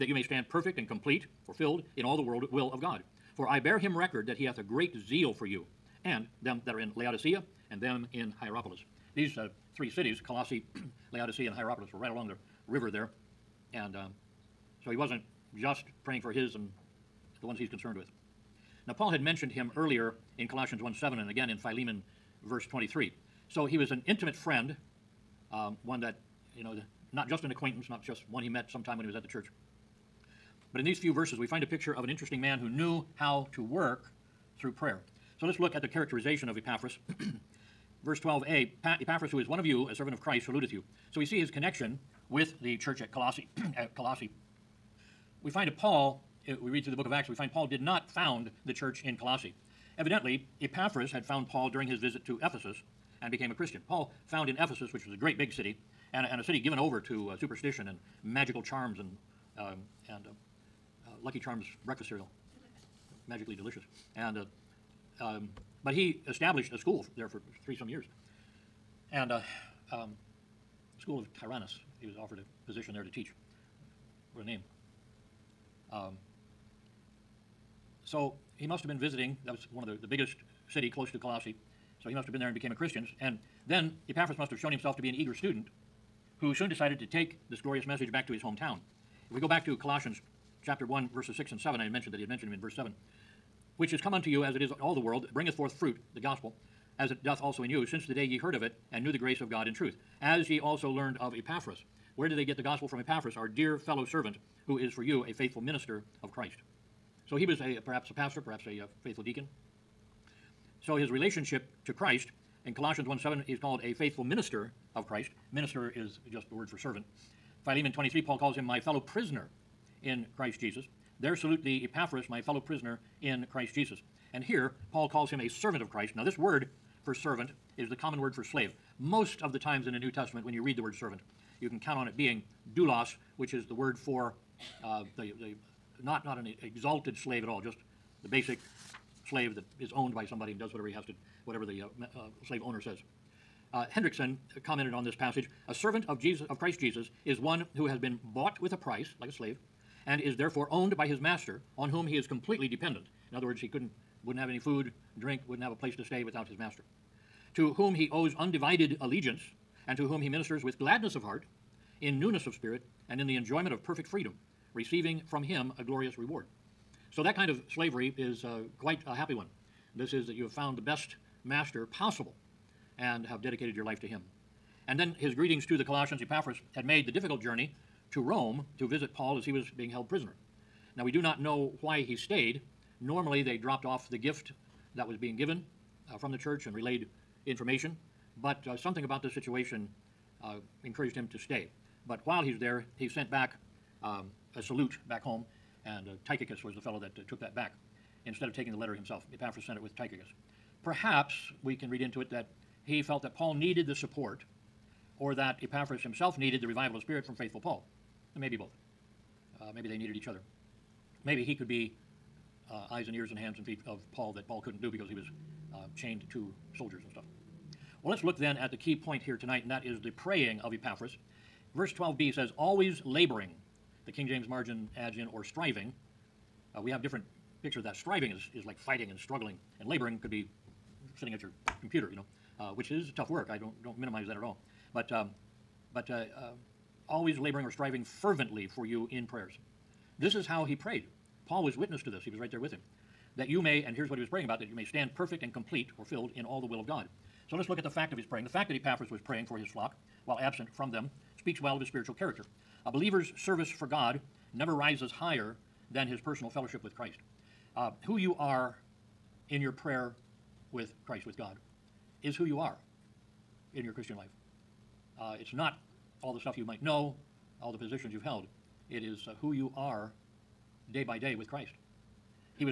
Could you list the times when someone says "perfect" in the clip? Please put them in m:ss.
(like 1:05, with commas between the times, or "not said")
0:00, 2:43, 4:05.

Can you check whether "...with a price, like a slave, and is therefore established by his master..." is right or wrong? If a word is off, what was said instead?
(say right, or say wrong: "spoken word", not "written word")
wrong: "owned", not "established".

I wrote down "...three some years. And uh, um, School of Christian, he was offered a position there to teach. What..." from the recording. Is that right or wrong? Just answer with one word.
wrong.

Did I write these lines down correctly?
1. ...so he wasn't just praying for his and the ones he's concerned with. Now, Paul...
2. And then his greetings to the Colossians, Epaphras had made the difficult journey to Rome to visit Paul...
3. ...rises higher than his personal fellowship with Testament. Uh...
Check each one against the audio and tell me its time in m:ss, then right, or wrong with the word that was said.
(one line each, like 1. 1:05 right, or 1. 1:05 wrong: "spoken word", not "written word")
1. 0:14 right
2. 2:54 right
3. 4:14 wrong: "Christ", not "Testament".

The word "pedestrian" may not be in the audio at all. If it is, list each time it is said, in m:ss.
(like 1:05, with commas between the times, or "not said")
not said.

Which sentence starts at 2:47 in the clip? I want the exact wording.
So that kind of slavery is uh, quite a happy one.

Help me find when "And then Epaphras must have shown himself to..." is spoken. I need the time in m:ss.
1:23.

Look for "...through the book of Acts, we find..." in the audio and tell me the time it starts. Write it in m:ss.
0:46.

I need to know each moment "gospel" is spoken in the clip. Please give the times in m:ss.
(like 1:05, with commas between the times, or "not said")
1:36, 1:42.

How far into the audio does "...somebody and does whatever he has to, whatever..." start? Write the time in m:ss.
2:20.